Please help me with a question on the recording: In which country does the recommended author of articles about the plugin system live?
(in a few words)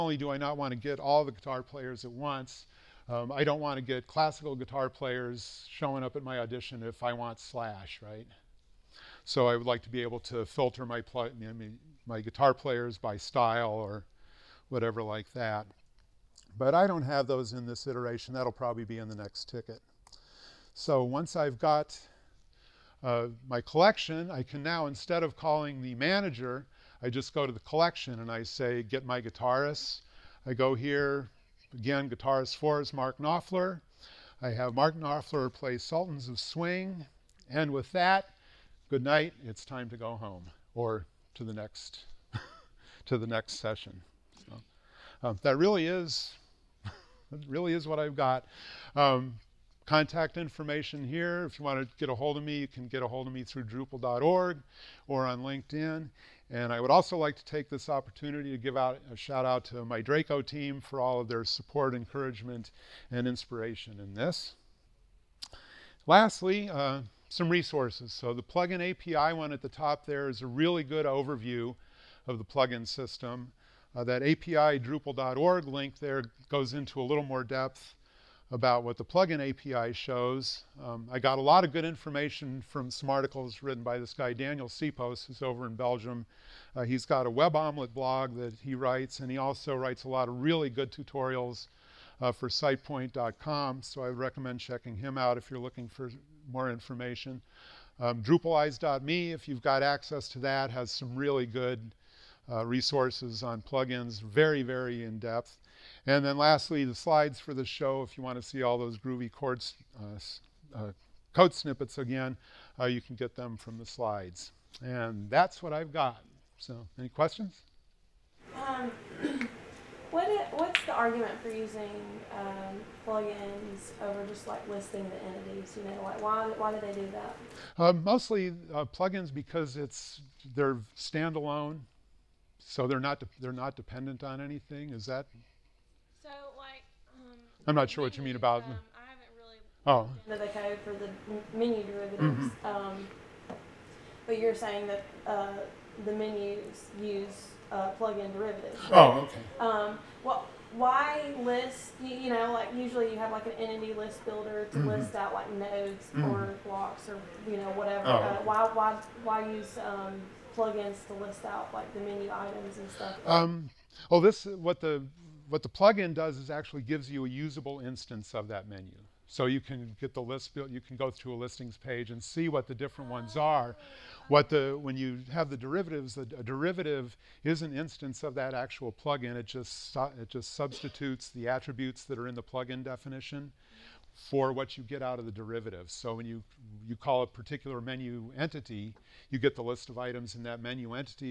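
Belgium.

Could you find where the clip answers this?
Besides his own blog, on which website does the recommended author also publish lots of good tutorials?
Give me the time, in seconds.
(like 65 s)
92 s.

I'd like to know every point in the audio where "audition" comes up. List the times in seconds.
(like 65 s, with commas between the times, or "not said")
6 s.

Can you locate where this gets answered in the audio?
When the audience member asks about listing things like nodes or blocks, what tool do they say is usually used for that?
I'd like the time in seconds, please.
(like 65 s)
153 s.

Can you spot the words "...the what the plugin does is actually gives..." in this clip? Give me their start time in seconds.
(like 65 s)
164 s.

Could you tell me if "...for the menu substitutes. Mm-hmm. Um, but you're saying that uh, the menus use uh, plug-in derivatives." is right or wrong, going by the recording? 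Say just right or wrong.
wrong.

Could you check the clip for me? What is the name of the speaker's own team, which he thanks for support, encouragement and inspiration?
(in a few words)
Draco.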